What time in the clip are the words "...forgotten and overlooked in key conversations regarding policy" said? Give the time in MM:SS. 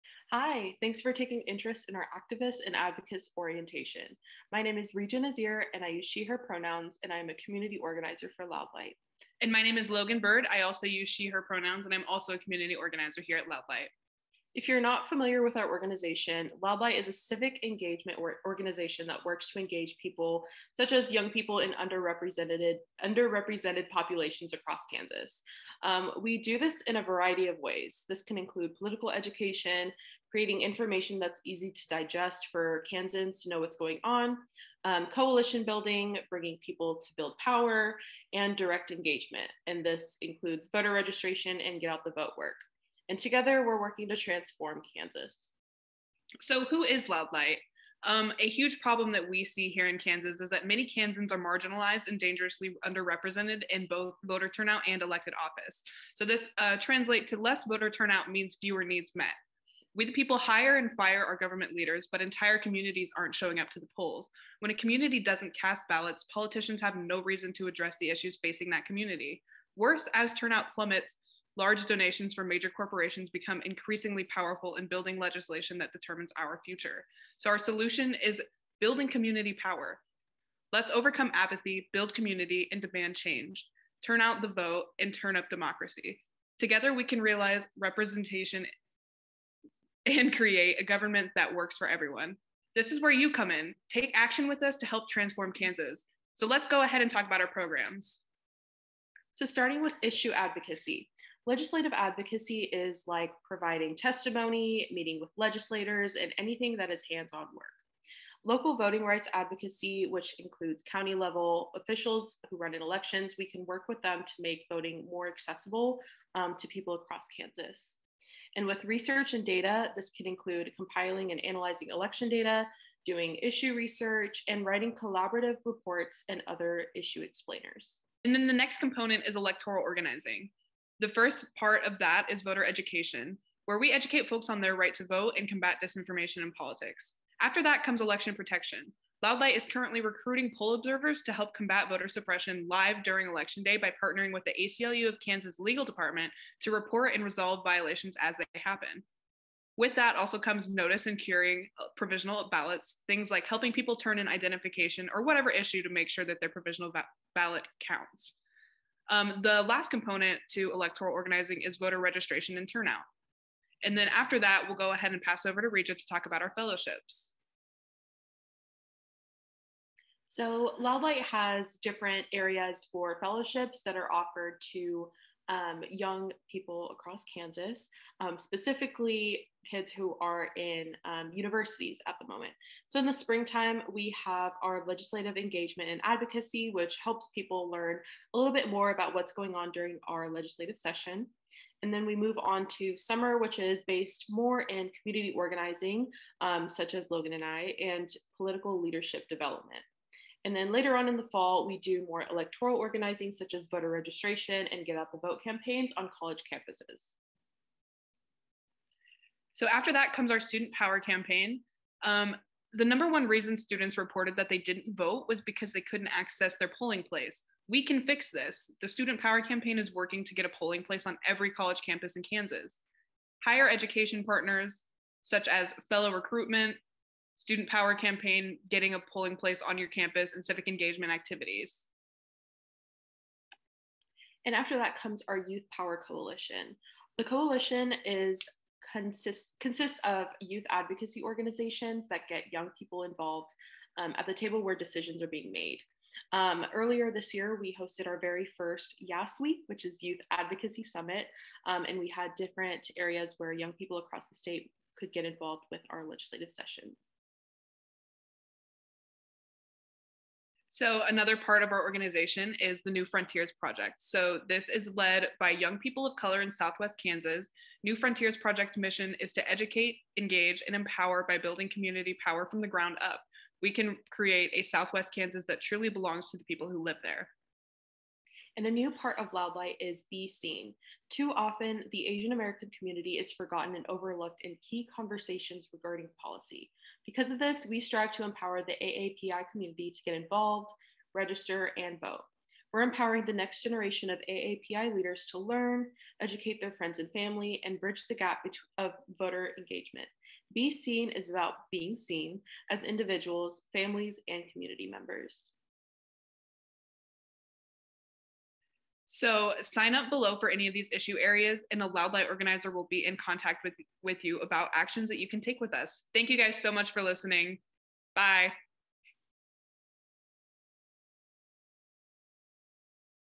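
04:43.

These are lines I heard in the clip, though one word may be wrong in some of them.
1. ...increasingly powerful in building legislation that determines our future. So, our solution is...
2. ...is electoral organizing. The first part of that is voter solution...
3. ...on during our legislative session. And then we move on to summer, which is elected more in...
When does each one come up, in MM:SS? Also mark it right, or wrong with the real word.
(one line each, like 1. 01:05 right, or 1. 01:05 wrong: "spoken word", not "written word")
1. 01:13 right
2. 02:09 wrong: "education", not "solution"
3. 03:09 wrong: "based", not "elected".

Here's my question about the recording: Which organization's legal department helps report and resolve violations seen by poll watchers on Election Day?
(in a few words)
ACLU of Kansas.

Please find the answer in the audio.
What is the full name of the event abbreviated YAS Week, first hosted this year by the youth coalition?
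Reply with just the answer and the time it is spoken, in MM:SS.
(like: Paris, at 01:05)
Youth Advocacy Summit, at 04:10.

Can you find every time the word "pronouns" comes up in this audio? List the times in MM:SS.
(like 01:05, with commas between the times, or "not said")
00:06, 00:11.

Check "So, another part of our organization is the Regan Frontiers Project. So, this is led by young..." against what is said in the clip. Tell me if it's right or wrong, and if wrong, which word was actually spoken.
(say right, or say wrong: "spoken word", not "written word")
wrong: "New", not "Regan".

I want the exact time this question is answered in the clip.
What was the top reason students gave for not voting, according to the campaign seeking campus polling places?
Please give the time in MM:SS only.
03:35.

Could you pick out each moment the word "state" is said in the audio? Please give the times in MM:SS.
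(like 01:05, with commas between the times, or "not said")
04:14.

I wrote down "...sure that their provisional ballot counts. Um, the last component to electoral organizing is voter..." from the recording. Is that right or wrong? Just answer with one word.
right.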